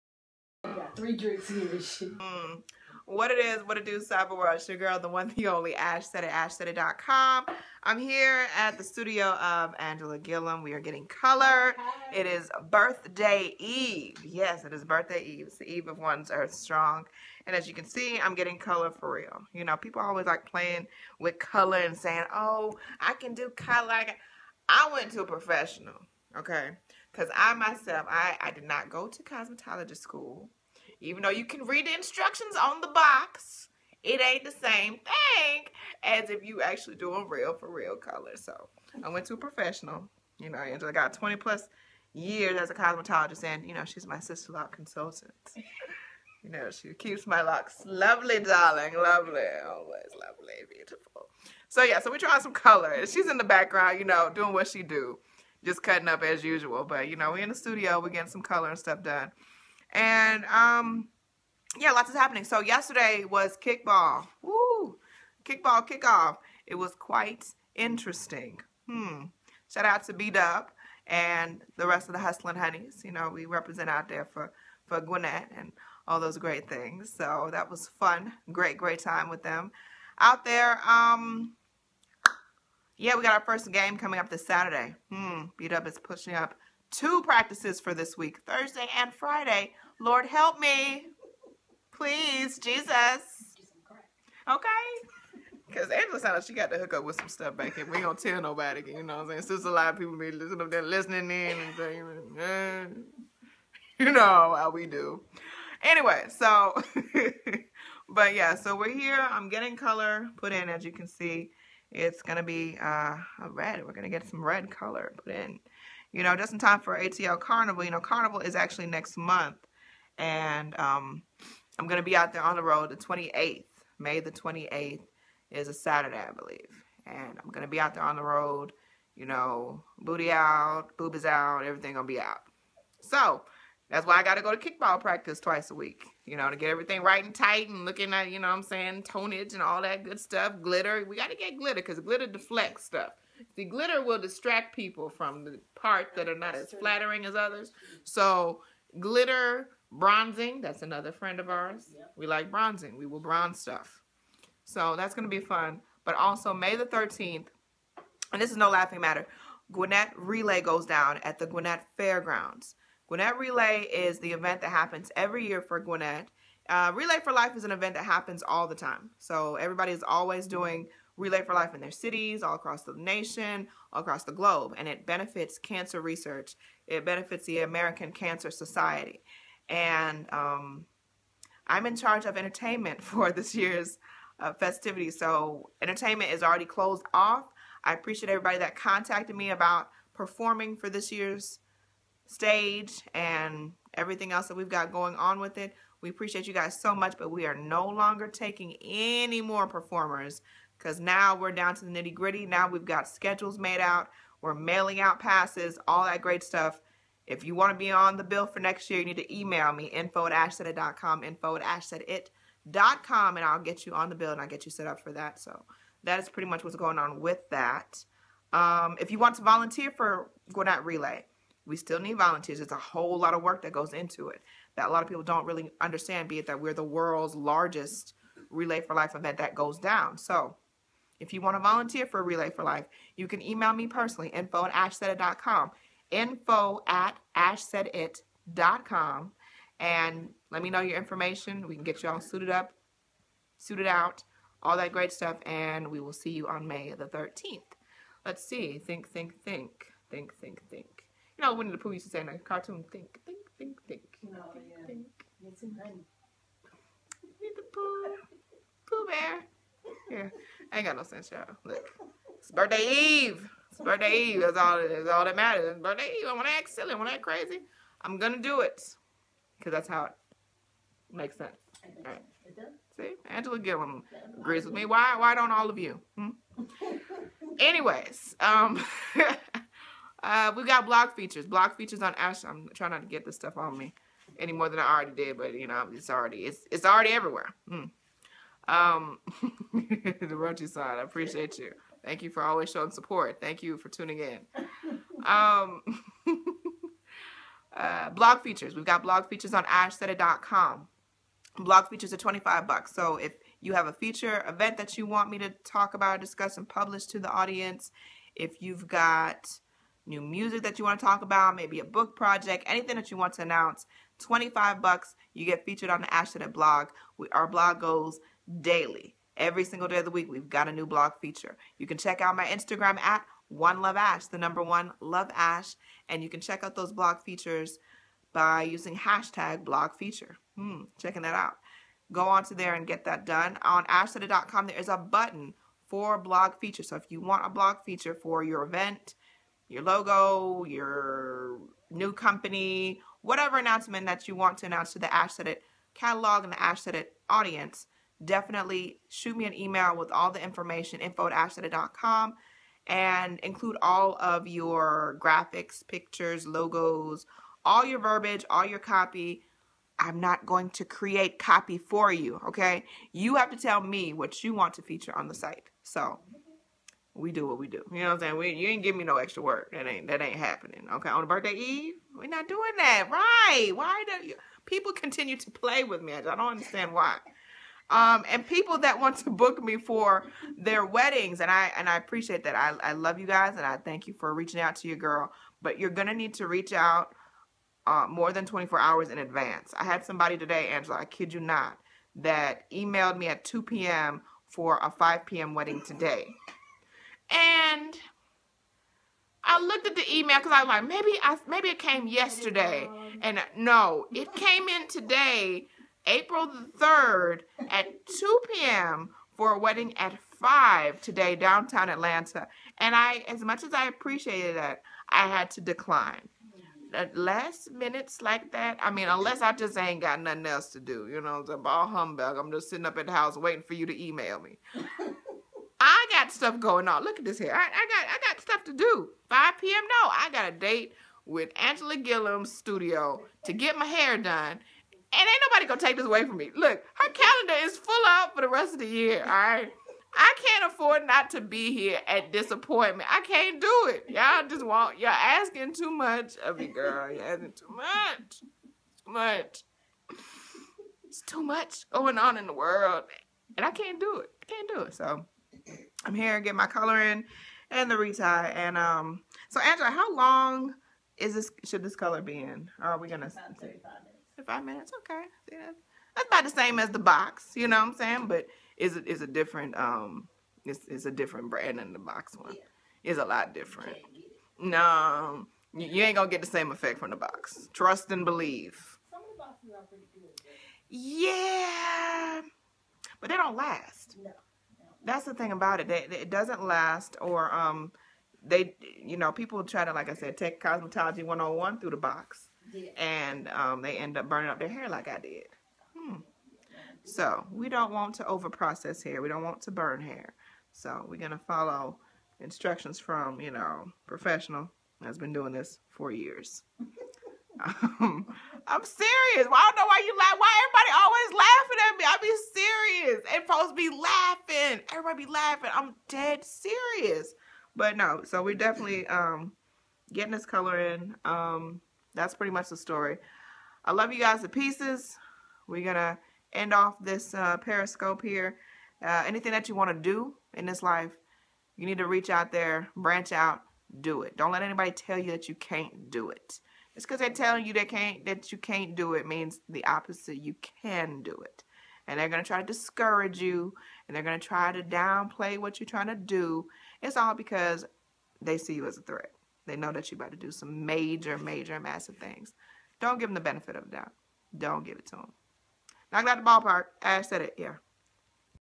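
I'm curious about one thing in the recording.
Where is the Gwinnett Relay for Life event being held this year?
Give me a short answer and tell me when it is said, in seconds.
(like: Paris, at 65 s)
Gwinnett Fairgrounds, at 161 s.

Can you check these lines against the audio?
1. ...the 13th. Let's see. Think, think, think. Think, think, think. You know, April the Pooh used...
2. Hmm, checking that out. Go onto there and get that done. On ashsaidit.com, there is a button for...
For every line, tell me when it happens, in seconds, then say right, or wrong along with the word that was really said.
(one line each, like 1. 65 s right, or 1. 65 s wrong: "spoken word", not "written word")
1. 246 s wrong: "Winnie", not "April"
2. 330 s right.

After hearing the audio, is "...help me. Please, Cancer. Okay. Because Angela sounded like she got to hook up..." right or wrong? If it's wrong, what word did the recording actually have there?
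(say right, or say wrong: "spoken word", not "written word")
wrong: "Jesus", not "Cancer".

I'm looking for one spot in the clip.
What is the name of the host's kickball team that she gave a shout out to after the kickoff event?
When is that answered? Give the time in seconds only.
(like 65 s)
72 s.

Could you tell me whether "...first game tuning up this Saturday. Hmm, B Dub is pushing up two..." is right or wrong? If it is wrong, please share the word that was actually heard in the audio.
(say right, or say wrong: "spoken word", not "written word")
wrong: "coming", not "tuning".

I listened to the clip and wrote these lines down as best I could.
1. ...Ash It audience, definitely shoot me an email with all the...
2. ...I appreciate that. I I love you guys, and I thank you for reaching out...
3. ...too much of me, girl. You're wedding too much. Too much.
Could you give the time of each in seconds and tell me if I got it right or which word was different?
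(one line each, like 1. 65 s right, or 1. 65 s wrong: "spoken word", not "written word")
1. 346 s right
2. 381 s right
3. 445 s wrong: "asking", not "wedding".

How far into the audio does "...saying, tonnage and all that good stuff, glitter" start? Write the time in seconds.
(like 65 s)
138 s.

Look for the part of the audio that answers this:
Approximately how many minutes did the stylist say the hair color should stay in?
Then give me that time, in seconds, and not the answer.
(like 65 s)
463 s.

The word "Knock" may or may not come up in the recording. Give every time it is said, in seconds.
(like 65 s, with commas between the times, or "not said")
556 s.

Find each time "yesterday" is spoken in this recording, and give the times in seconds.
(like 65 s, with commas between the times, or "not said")
62 s, 402 s.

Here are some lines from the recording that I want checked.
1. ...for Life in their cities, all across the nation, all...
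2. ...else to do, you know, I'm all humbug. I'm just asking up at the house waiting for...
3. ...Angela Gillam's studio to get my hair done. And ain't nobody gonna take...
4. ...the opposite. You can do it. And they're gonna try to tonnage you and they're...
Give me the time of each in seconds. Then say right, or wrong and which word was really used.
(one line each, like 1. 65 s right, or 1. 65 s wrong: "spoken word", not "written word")
1. 171 s right
2. 420 s wrong: "sitting", not "asking"
3. 431 s right
4. 539 s wrong: "discourage", not "tonnage".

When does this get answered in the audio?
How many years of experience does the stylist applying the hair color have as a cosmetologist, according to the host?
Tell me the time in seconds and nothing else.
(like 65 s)
41 s.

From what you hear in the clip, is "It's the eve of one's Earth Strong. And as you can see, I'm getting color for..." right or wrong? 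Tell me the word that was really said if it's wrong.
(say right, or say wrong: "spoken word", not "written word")
right.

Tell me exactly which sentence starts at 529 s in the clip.
Uh, anything that you want to do in this life, you need to reach out there, branch out, do it.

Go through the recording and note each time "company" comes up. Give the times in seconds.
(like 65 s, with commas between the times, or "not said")
342 s.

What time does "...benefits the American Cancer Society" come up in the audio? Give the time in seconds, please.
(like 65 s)
177 s.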